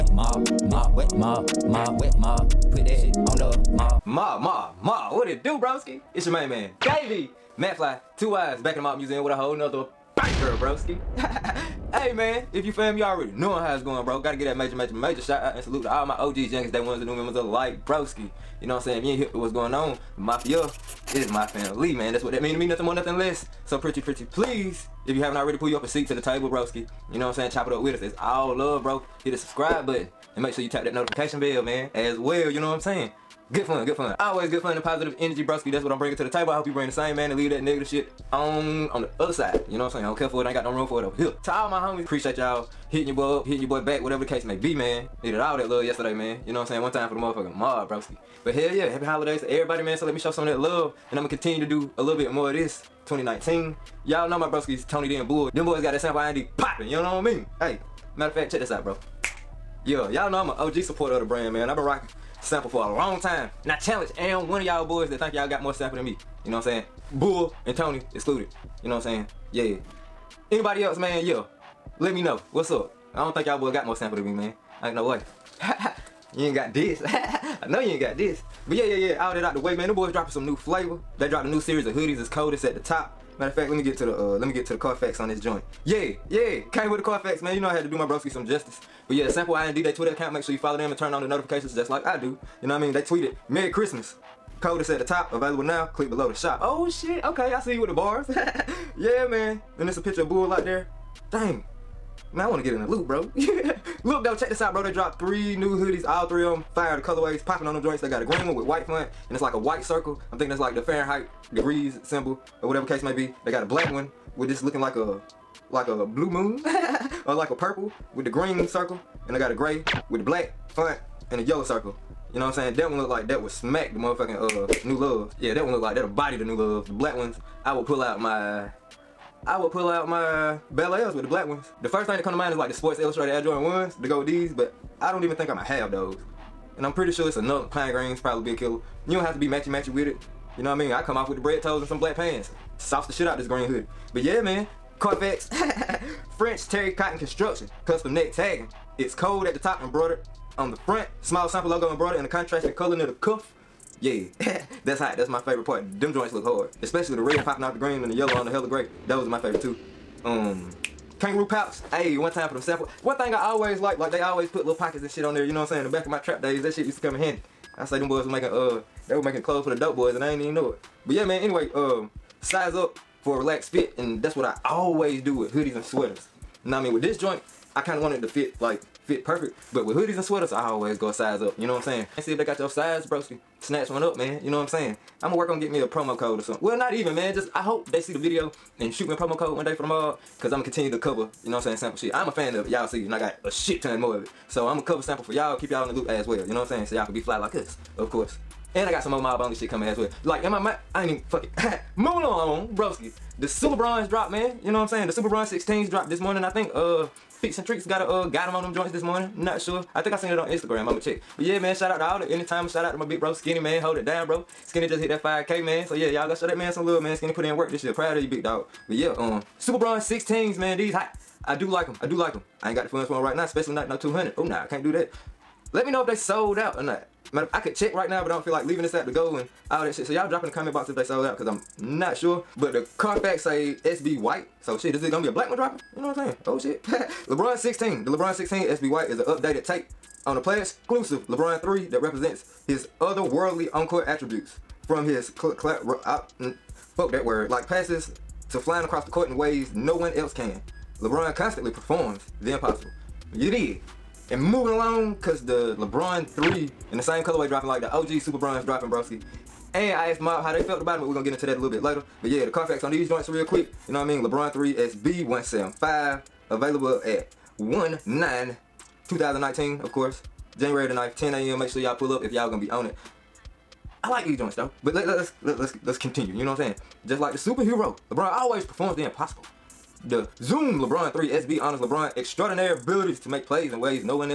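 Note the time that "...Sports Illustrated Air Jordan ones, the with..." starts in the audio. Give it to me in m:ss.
2:12.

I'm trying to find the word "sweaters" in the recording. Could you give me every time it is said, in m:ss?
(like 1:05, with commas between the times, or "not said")
2:55, 3:00.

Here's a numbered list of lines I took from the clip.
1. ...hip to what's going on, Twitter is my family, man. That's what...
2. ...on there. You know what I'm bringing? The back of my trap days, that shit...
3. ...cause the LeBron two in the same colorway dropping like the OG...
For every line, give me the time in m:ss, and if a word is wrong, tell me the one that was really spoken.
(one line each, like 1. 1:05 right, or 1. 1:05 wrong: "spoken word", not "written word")
1. 0:19 wrong: "Mafia", not "Twitter"
2. 2:45 wrong: "saying", not "bringing"
3. 4:15 wrong: "three", not "two".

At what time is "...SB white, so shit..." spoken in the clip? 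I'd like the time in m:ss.
3:53.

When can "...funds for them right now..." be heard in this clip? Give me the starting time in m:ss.
3:42.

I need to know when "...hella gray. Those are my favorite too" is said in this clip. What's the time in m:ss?
2:38.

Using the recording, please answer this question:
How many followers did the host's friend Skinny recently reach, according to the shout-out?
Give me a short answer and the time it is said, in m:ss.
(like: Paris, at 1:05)
5K, at 3:35.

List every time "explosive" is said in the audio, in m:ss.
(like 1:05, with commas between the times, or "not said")
not said.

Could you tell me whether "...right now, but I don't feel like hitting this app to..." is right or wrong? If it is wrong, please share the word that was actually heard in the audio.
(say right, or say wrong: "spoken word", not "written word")
wrong: "leaving", not "hitting".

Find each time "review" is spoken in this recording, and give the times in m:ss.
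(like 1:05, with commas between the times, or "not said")
not said.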